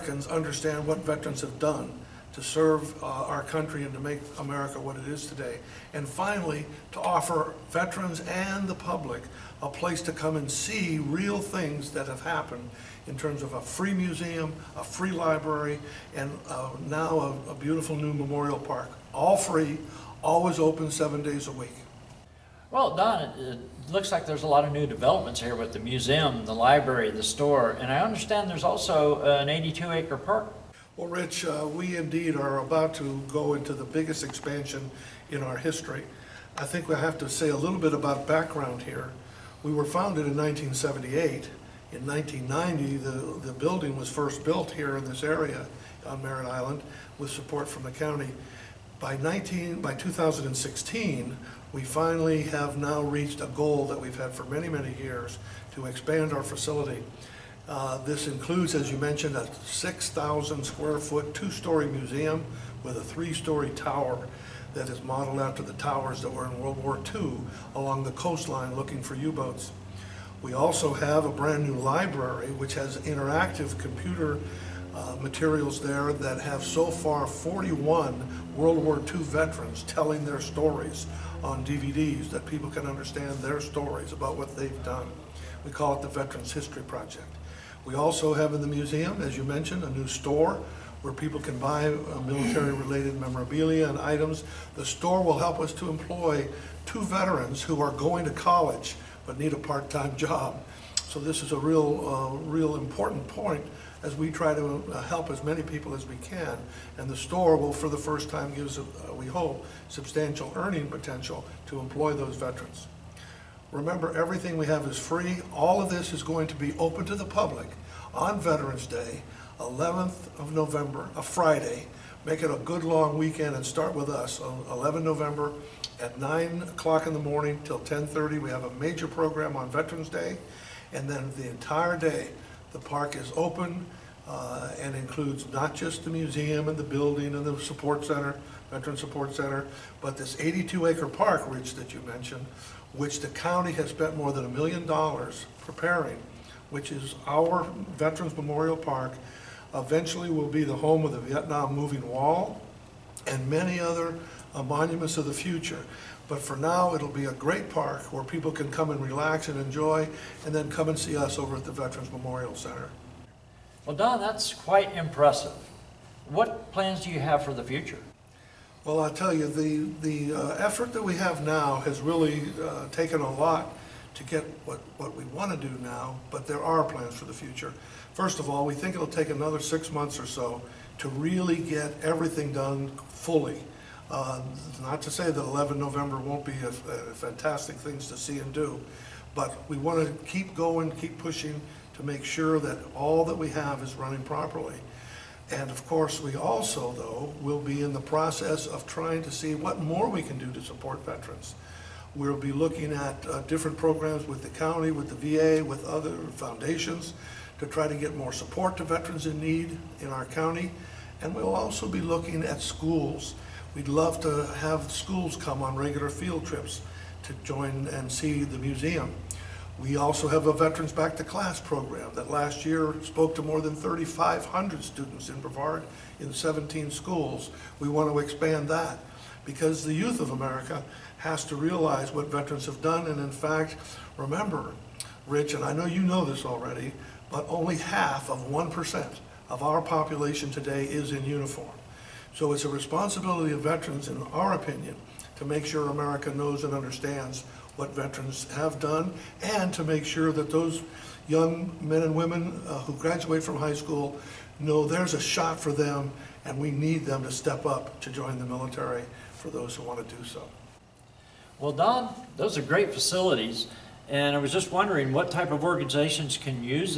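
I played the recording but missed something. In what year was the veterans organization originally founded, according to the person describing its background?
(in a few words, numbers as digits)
1978.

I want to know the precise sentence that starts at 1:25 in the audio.
We call it the Veterans History Project.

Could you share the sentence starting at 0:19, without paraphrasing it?
All free, always open seven days a week.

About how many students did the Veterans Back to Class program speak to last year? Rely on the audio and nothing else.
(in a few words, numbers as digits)
3,500.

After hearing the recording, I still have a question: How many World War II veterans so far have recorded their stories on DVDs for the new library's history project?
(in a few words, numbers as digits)
41.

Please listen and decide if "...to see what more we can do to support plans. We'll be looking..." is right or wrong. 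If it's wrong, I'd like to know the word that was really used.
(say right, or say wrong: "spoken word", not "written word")
wrong: "veterans", not "plans".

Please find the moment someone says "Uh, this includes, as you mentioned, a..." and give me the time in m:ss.
0:57.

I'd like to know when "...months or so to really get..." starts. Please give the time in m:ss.
2:59.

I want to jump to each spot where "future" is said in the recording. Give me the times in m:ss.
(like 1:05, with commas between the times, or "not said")
2:35, 2:47, 2:57.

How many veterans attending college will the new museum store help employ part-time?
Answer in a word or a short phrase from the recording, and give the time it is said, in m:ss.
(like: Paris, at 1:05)
2, at 1:36.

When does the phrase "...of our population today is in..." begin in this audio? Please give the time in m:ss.
3:59.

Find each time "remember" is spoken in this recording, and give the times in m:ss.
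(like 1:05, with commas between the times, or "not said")
1:53, 3:54.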